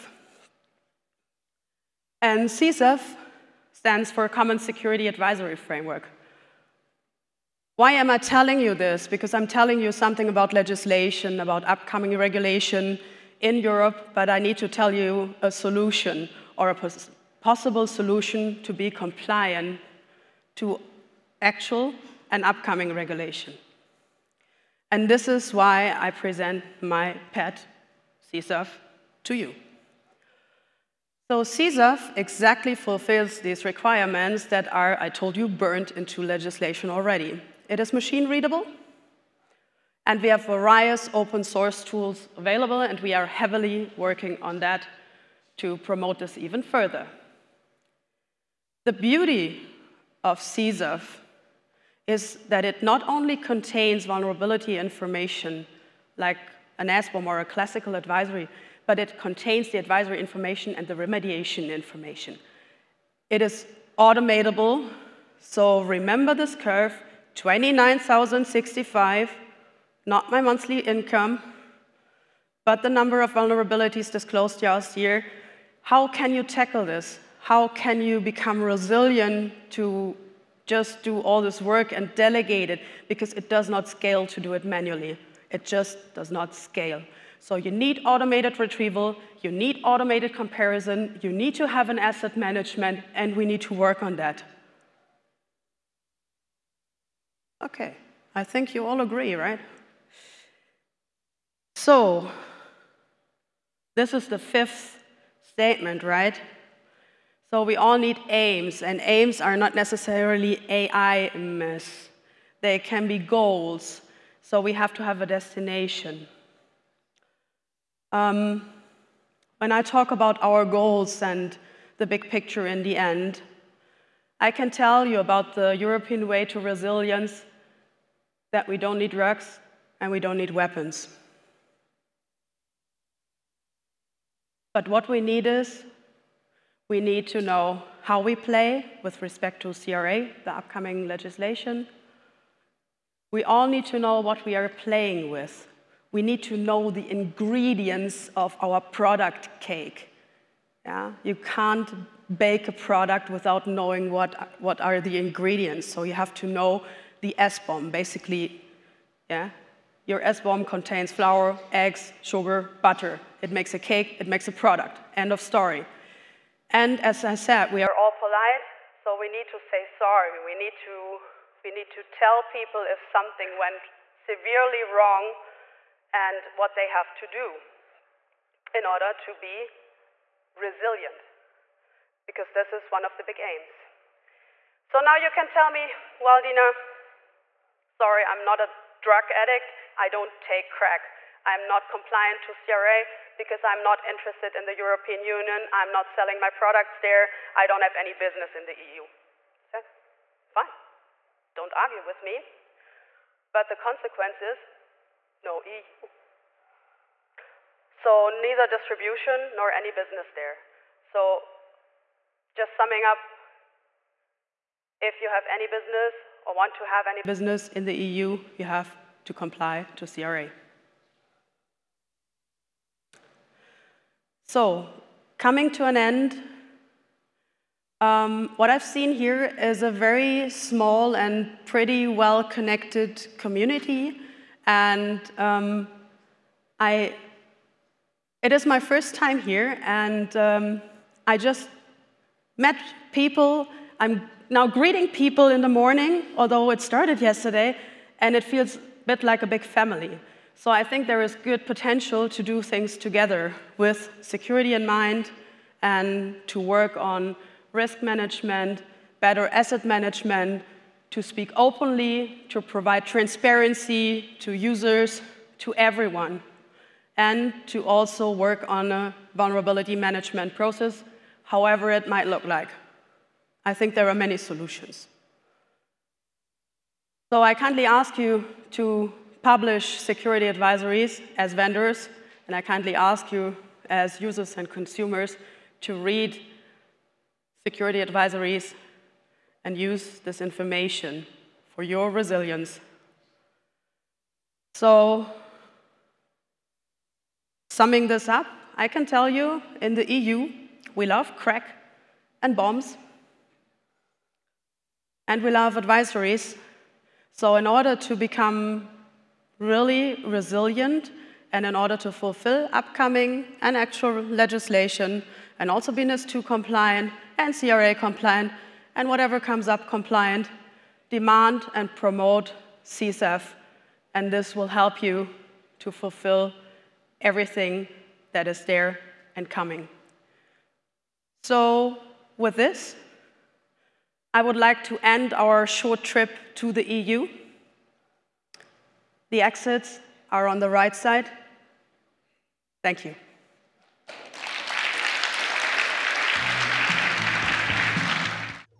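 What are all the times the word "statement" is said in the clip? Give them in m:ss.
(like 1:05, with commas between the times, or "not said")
1:45.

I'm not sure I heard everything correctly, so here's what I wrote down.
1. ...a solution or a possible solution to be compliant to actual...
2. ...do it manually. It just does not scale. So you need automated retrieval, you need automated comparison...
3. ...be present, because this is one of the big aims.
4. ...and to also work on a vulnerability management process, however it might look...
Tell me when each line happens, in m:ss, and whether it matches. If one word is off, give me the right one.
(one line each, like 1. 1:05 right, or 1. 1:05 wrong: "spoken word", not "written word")
1. 0:15 right
2. 1:24 right
3. 2:59 wrong: "resilient", not "present"
4. 4:27 right.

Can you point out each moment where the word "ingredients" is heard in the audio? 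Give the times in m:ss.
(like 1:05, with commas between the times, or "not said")
2:27, 2:35.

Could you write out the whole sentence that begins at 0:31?
So CSAF exactly fulfills these requirements that are, I told you, burned into legislation already.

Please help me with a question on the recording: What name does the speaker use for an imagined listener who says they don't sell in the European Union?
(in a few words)
Dina.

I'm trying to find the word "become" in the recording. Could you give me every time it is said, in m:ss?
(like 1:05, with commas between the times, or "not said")
1:18, 5:08.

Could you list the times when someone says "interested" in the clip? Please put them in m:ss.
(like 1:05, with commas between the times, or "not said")
3:14.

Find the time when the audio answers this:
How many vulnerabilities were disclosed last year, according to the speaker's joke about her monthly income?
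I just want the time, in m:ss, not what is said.
1:07.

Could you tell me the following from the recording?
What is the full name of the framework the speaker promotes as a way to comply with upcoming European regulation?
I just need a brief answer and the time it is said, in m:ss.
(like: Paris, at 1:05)
Common Security Advisory Framework, at 0:04.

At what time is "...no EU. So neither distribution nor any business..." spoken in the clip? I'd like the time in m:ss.
3:25.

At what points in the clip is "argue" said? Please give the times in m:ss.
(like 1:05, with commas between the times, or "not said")
3:21.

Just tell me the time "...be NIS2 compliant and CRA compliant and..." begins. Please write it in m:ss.
5:15.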